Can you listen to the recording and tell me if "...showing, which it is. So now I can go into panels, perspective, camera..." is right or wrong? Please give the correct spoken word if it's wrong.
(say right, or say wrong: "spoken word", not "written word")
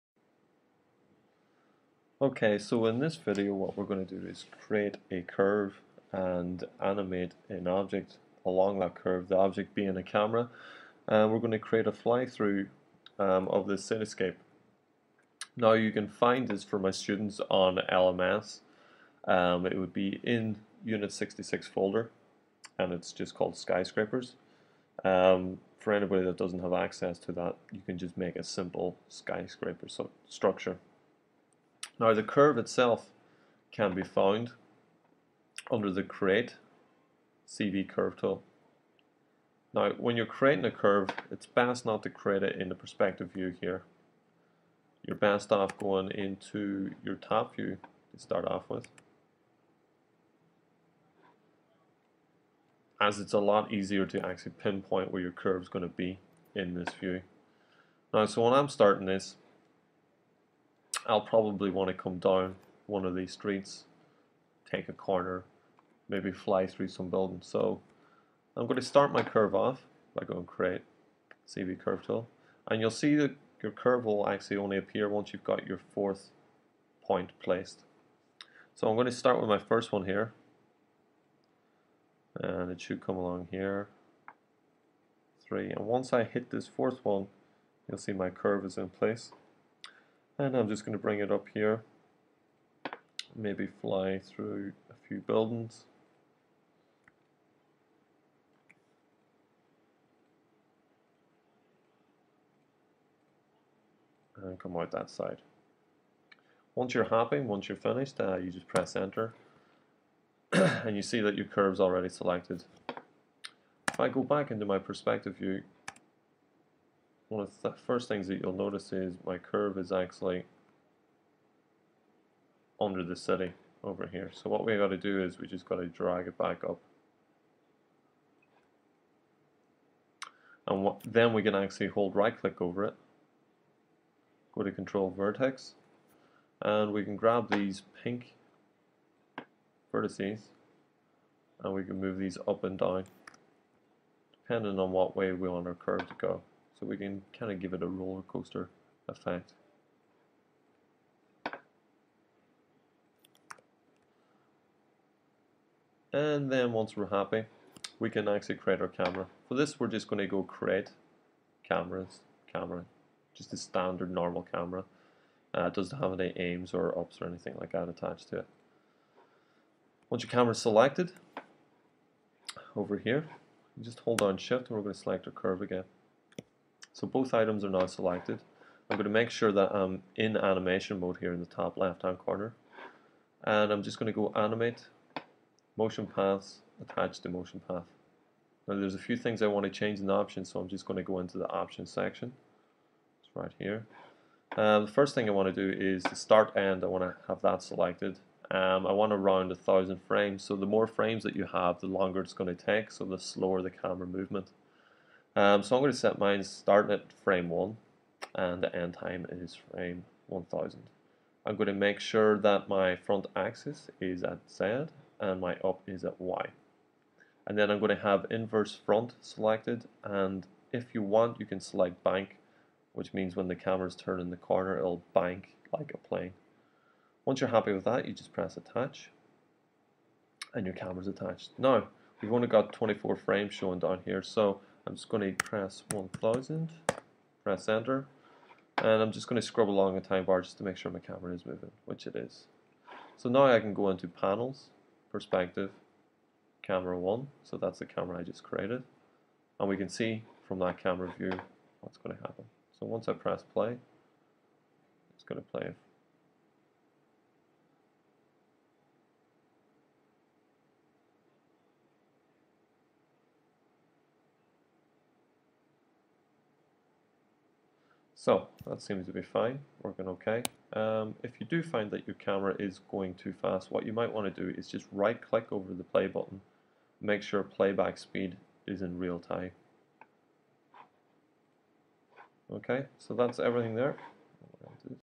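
wrong: "moving", not "showing".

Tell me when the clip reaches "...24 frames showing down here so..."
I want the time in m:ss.
3:52.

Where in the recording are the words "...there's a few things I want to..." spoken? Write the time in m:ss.
3:08.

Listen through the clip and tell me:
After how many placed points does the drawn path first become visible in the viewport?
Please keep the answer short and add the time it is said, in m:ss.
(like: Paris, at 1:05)
4, at 1:15.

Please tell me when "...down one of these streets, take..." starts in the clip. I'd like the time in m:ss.
1:02.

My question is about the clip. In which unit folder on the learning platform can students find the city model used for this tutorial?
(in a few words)
Unit 66.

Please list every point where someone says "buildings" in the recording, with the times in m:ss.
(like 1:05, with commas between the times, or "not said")
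1:07, 1:35.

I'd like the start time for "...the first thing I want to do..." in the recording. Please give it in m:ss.
3:14.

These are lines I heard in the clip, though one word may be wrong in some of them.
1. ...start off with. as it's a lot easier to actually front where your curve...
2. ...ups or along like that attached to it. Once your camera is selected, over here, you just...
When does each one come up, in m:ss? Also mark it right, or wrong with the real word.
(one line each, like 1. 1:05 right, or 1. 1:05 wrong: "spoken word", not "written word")
1. 0:48 wrong: "pinpoint", not "front"
2. 2:46 wrong: "anything", not "along".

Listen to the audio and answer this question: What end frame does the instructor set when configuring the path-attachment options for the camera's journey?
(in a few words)
1000.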